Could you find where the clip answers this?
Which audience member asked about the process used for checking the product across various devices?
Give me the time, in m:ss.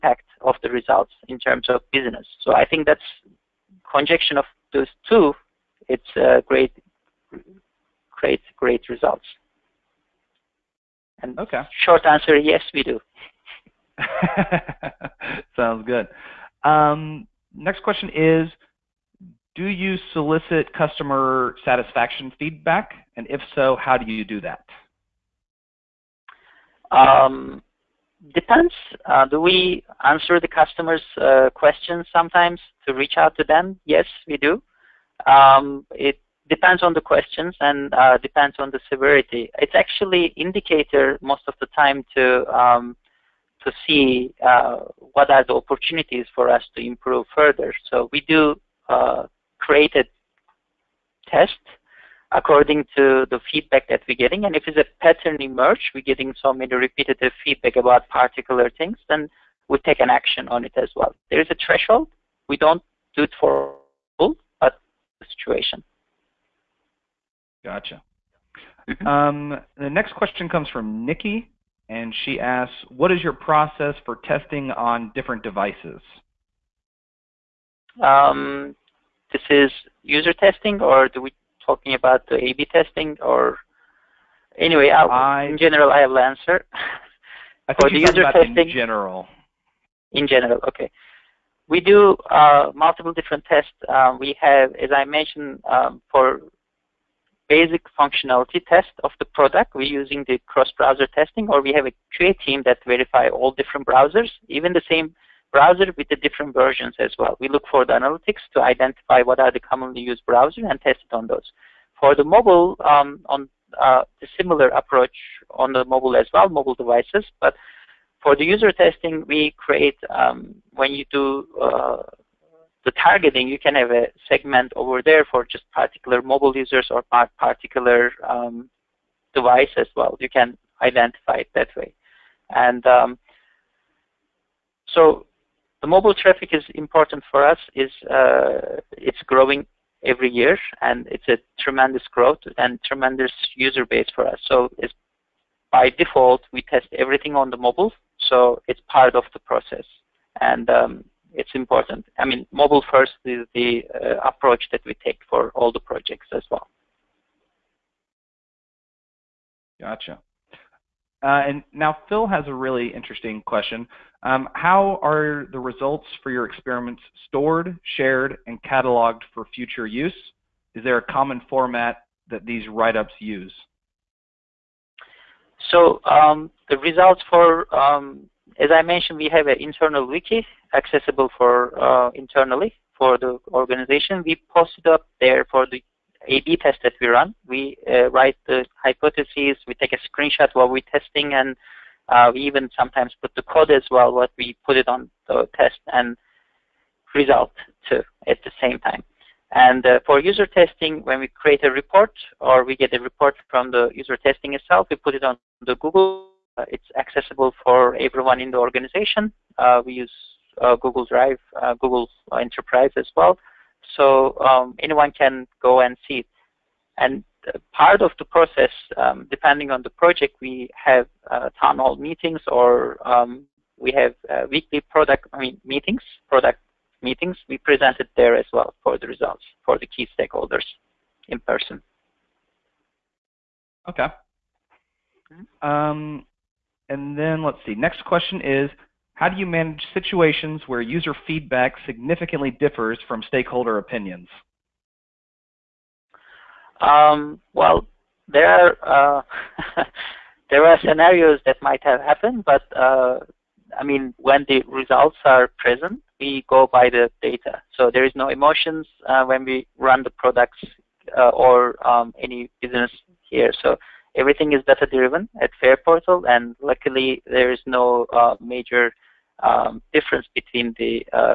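1:11.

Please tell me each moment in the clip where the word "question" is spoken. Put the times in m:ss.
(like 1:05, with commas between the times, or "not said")
0:17, 0:31, 0:36, 1:10, 2:43, 3:58.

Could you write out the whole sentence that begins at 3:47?
We present it there as well for the results for the key stakeholders in person.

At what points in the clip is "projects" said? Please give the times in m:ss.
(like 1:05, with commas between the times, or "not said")
2:35, 3:39.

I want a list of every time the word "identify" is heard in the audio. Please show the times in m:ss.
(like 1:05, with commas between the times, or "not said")
1:48, 2:10.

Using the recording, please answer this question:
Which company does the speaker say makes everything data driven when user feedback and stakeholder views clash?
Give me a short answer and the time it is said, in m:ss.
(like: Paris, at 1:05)
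Fareportal, at 4:25.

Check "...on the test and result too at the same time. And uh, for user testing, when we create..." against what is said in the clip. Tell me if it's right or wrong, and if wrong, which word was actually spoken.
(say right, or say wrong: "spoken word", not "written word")
right.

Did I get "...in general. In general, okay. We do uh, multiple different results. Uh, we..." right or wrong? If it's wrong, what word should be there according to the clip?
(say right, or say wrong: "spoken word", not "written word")
wrong: "tests", not "results".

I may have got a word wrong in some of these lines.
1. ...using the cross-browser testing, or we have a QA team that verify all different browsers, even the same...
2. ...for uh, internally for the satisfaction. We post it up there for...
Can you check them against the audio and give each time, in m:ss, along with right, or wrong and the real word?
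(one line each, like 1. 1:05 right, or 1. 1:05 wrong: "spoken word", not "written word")
1. 1:39 right
2. 3:01 wrong: "organization", not "satisfaction".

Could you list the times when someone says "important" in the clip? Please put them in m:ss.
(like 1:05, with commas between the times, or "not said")
2:16, 2:31.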